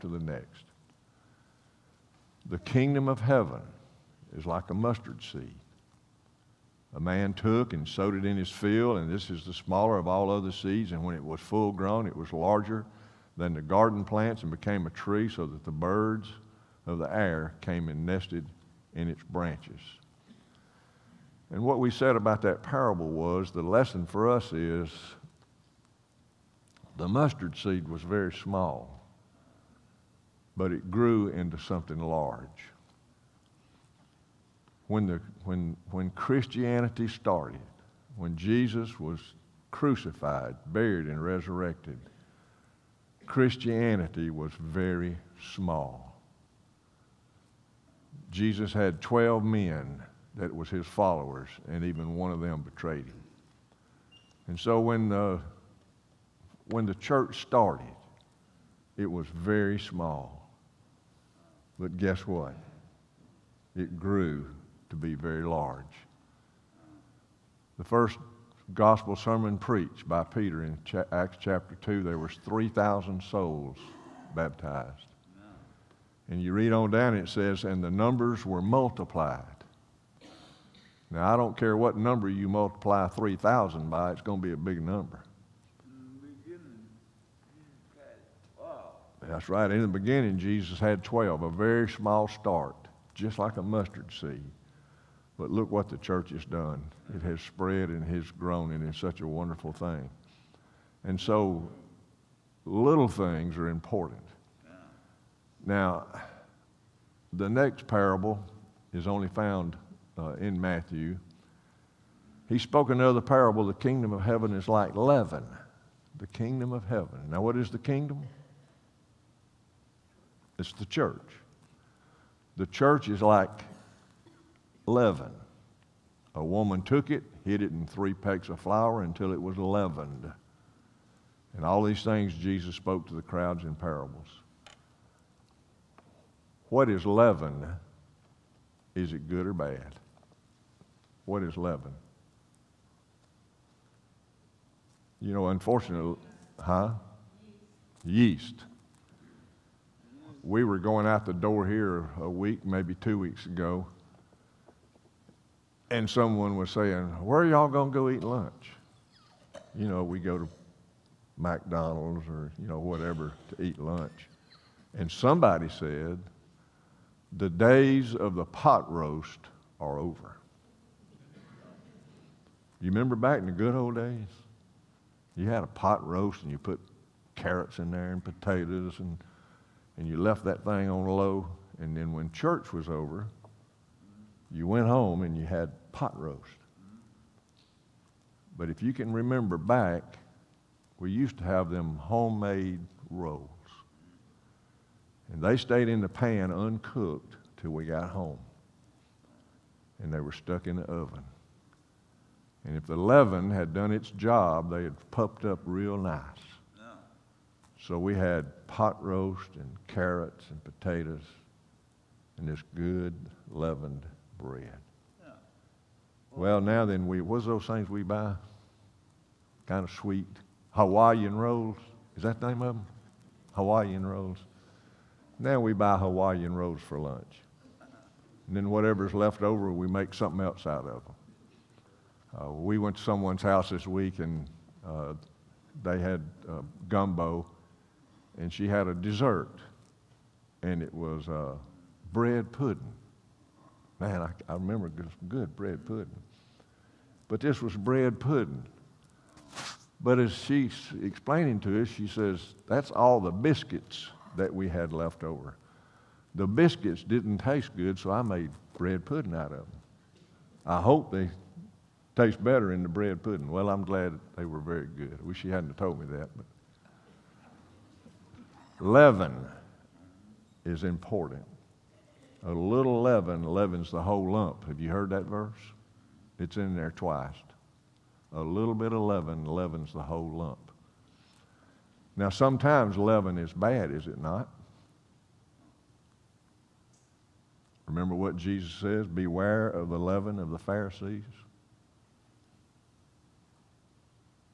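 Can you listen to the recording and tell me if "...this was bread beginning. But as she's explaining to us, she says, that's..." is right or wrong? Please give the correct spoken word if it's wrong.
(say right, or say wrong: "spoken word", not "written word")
wrong: "pudding", not "beginning".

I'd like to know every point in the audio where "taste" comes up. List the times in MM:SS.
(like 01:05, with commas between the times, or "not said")
04:17, 04:22.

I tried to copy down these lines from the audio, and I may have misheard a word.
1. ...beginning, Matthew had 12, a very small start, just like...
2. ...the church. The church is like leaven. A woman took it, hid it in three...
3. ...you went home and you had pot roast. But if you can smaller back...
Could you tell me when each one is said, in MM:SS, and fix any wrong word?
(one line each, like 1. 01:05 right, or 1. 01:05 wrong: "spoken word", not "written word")
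1. 01:29 wrong: "Jesus", not "Matthew"
2. 02:00 right
3. 03:04 wrong: "remember", not "smaller".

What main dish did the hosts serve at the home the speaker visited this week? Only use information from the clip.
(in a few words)
Gumbo.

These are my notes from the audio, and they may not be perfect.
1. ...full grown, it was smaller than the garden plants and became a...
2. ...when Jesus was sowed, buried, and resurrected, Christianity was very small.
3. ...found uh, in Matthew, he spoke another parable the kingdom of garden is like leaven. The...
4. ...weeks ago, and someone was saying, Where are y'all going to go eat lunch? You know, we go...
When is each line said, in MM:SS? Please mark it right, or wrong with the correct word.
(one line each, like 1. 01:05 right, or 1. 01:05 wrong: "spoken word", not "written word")
1. 00:11 wrong: "larger", not "smaller"
2. 00:38 wrong: "crucified", not "sowed"
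3. 01:49 wrong: "heaven", not "garden"
4. 02:33 right.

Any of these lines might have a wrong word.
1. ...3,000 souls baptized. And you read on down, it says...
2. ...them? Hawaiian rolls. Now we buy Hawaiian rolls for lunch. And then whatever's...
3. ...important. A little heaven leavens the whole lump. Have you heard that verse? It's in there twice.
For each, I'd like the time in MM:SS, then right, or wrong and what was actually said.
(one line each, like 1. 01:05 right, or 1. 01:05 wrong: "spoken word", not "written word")
1. 01:12 right
2. 03:42 right
3. 04:30 wrong: "leaven", not "heaven".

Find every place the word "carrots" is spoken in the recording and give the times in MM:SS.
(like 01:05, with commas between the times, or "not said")
02:57, 03:29.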